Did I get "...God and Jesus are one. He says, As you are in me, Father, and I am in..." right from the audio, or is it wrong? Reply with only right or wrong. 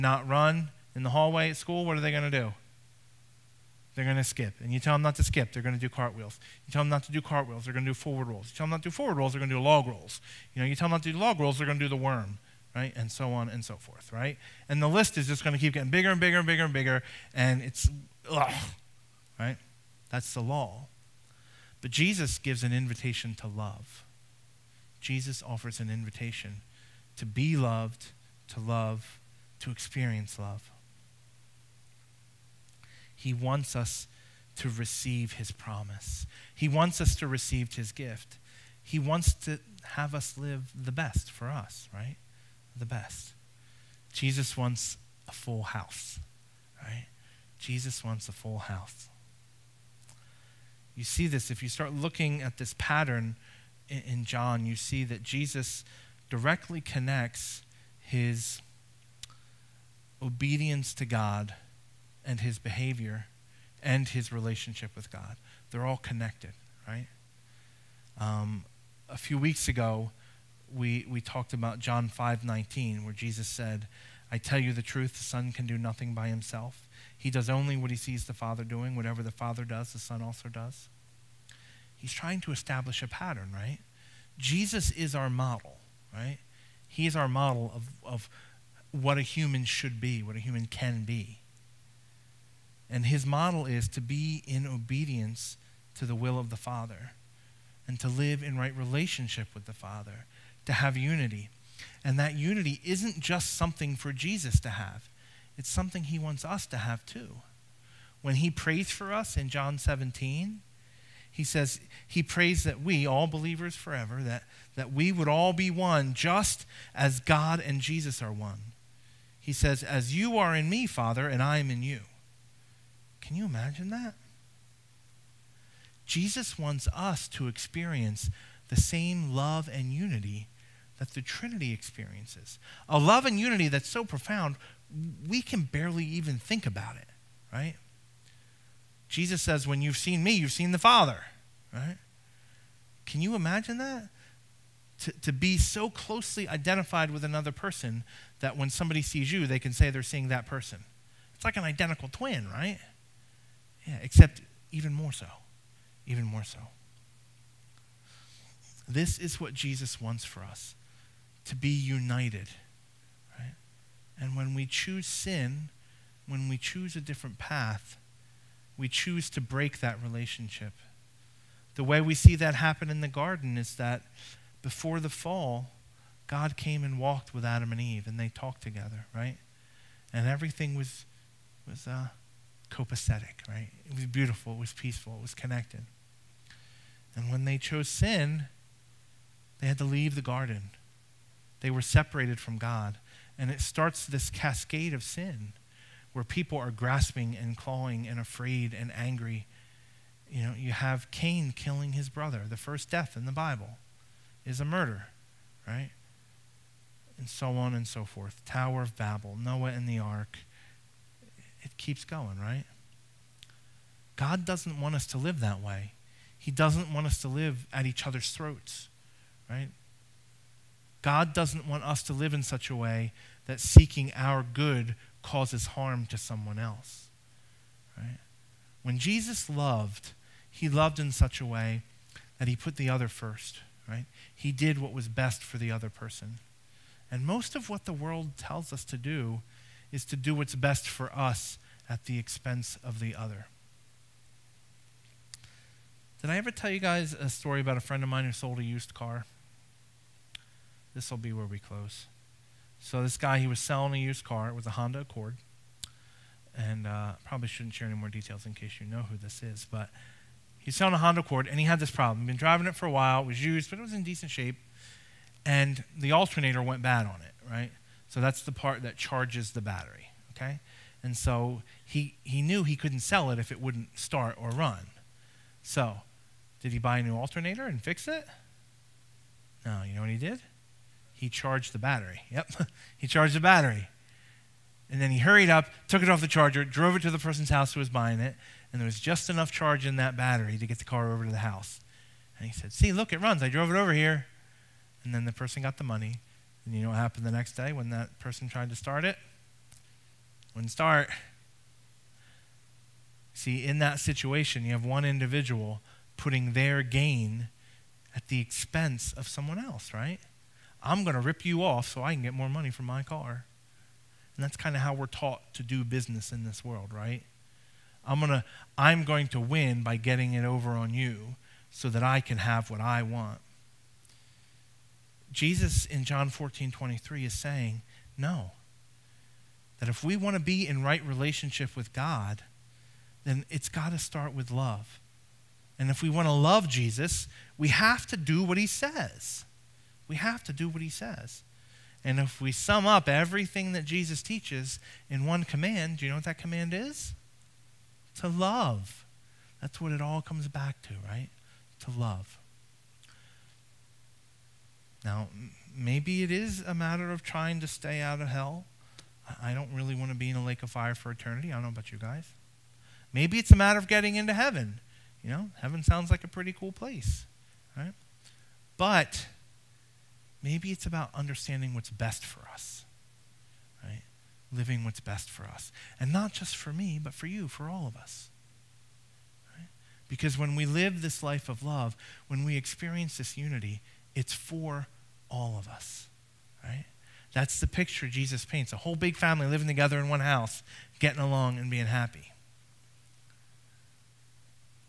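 right.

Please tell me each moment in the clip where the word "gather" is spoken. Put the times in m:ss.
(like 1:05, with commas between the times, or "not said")
not said.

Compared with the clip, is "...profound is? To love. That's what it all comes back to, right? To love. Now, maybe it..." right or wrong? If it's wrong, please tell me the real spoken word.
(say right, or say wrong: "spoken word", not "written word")
wrong: "command", not "profound".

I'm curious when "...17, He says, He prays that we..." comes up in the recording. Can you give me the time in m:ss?
1:49.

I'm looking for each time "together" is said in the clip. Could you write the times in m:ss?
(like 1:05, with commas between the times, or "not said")
2:58, 6:29.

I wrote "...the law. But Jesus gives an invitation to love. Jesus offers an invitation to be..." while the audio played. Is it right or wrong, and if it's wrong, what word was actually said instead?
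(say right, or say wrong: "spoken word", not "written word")
right.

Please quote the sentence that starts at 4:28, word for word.
So that's the part that charges the battery, okay?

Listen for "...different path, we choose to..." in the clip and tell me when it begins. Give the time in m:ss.
2:46.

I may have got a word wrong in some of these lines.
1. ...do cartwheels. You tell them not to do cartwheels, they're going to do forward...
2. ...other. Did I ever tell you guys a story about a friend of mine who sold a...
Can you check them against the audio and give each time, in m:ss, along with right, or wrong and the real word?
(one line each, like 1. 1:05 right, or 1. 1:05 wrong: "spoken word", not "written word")
1. 0:05 right
2. 4:03 right.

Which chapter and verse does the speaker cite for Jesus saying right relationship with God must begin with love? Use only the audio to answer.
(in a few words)
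John 14:23.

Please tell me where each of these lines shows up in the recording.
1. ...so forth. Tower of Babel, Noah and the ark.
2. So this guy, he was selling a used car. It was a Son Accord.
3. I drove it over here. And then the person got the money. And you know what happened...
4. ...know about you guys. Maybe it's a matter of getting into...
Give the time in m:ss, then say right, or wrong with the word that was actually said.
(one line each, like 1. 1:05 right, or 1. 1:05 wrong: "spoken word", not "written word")
1. 3:27 right
2. 4:12 wrong: "Honda", not "Son"
3. 4:53 right
4. 6:01 right.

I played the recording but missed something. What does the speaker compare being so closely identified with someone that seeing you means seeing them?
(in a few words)
identical twin.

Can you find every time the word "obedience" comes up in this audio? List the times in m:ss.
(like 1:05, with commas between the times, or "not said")
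1:00, 1:34.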